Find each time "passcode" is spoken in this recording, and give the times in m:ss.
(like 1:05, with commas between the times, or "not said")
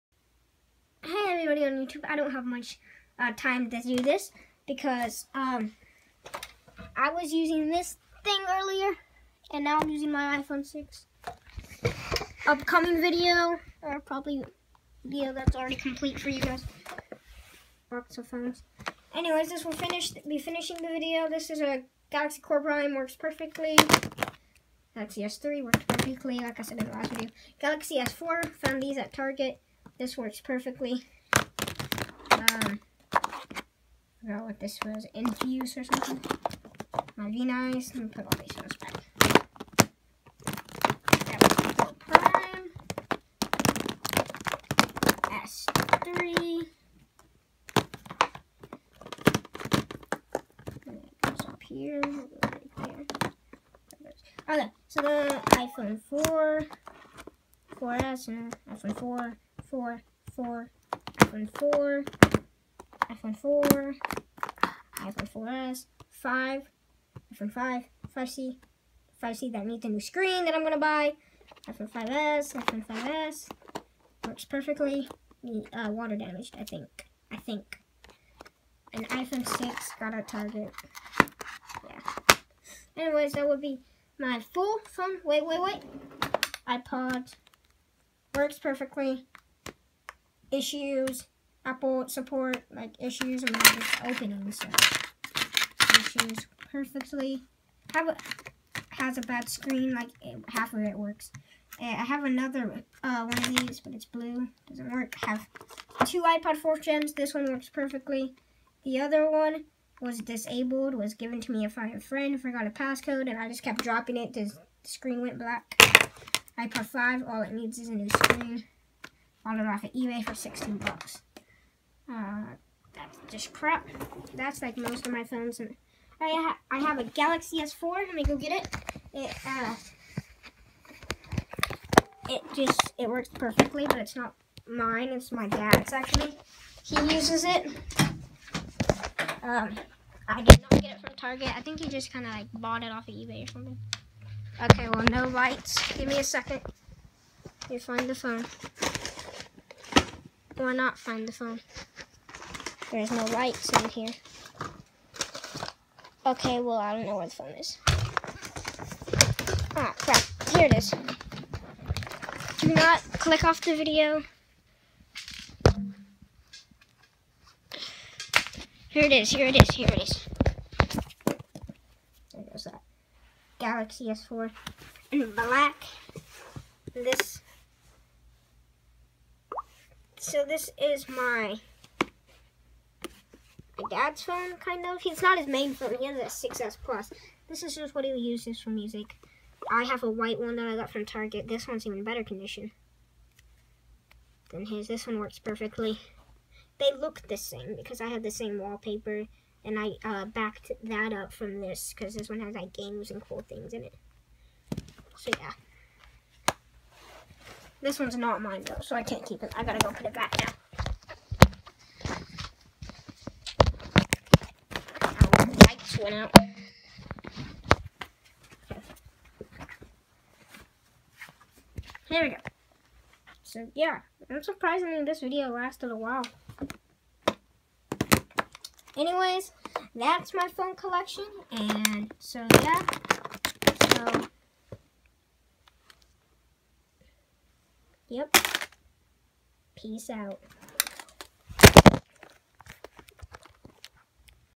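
1:52.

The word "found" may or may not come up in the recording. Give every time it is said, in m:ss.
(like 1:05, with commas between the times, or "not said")
0:28.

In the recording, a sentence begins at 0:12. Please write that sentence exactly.
Upcoming video, or probably video that's already complete for you guys.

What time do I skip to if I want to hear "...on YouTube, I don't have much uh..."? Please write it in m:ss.
0:01.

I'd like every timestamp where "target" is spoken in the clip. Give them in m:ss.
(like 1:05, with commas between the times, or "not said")
0:29, 1:20, 2:21, 3:11.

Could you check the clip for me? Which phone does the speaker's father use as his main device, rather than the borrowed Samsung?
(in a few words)
6S Plus.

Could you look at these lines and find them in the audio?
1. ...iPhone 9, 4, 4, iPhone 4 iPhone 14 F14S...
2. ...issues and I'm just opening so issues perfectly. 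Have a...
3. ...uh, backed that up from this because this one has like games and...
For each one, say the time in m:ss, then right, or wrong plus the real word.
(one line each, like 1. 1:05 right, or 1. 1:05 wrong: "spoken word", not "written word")
1. 0:58 wrong: "4", not "9"
2. 1:32 right
3. 3:20 right.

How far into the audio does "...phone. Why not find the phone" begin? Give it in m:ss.
2:28.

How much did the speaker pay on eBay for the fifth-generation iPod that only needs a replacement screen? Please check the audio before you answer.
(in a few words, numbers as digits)
$16.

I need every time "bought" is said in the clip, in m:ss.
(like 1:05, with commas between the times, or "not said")
1:59, 2:22.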